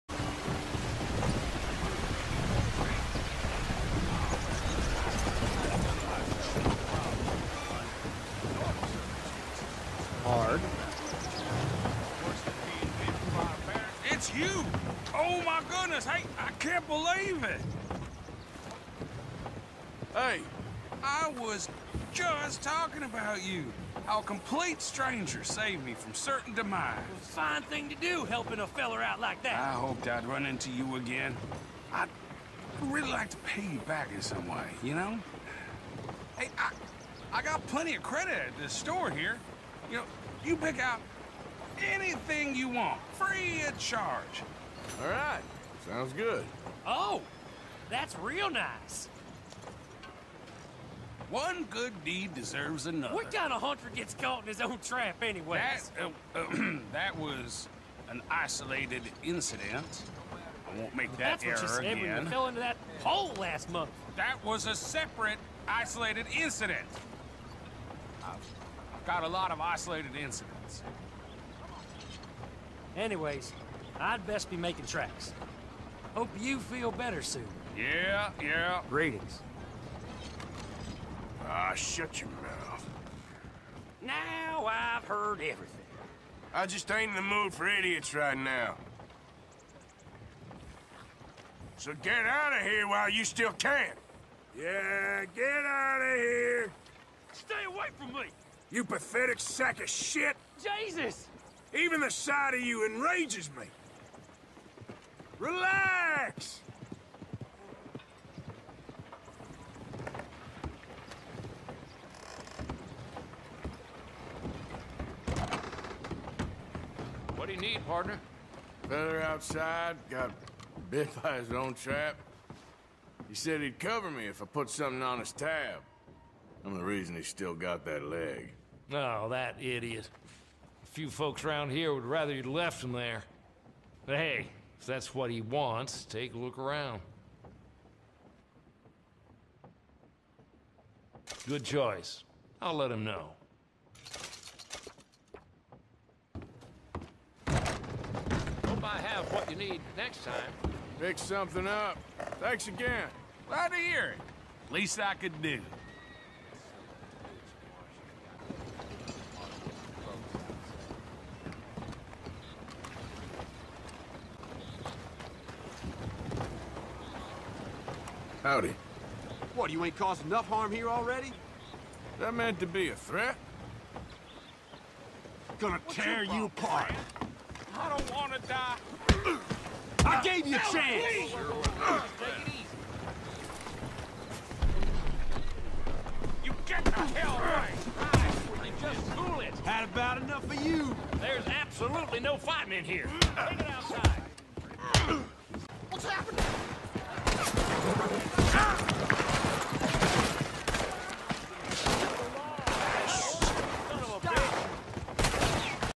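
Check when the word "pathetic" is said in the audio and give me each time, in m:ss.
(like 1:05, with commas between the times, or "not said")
1:38.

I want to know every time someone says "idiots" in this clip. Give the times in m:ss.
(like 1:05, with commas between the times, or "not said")
1:27, 2:09.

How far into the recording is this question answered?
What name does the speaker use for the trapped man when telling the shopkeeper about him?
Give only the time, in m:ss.
1:58.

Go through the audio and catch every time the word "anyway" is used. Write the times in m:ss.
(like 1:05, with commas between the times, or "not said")
0:55, 1:12.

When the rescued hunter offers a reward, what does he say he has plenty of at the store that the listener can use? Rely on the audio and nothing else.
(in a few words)
Credit.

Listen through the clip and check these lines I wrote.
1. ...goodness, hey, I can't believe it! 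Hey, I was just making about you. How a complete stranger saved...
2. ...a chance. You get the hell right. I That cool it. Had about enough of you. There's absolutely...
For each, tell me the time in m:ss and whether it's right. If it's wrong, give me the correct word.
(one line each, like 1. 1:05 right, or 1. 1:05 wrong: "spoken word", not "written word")
1. 0:15 wrong: "talking", not "making"
2. 3:00 wrong: "Just", not "That".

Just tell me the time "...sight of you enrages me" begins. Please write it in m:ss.
1:42.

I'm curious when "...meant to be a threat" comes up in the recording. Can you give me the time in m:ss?
2:52.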